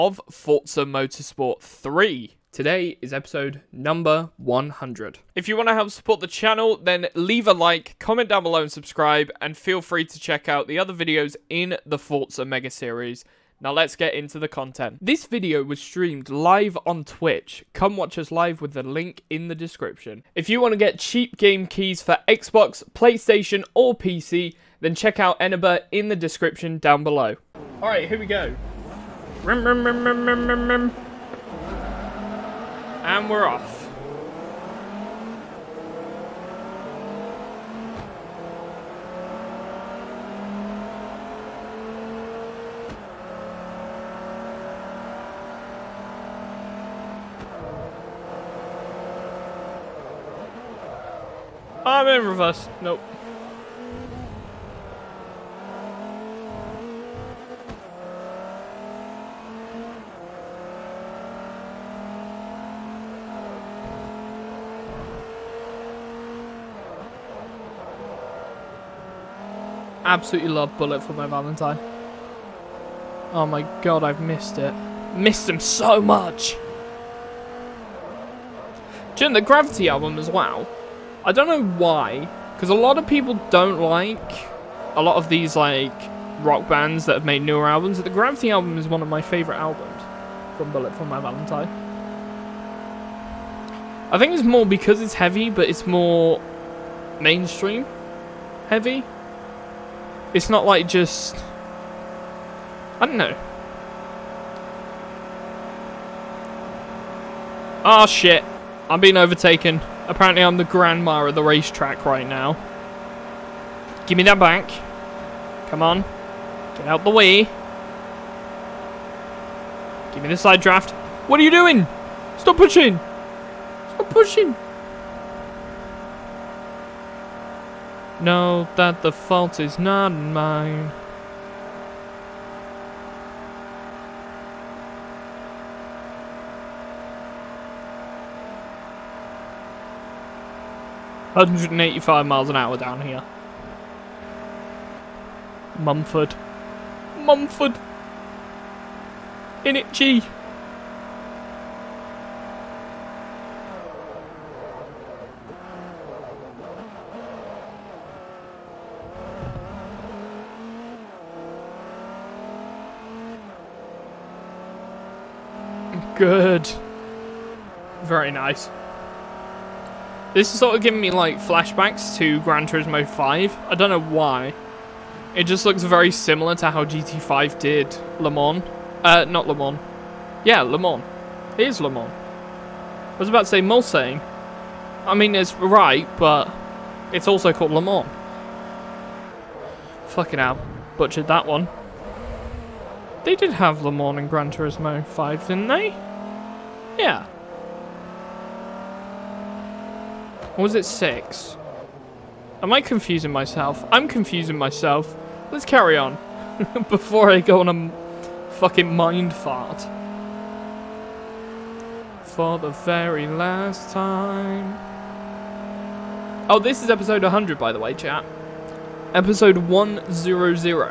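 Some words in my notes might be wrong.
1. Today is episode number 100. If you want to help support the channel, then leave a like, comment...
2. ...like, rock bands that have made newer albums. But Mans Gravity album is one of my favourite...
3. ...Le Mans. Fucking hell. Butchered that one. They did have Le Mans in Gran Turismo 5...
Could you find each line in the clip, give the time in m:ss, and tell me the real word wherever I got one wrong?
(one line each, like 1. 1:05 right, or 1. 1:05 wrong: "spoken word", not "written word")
1. 0:02 right
2. 1:25 wrong: "The", not "Mans"
3. 3:07 right.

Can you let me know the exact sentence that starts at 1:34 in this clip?
I think it's more because it's heavy, but it's more mainstream heavy.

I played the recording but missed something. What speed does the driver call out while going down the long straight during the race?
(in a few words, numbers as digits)
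185 mph.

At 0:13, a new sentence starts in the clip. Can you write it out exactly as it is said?
Now let's get into the content.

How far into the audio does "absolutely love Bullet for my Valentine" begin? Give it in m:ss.
1:10.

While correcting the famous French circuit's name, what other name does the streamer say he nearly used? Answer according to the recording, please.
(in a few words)
Mulsanne.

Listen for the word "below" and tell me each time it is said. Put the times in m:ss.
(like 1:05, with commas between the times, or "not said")
0:08, 0:27.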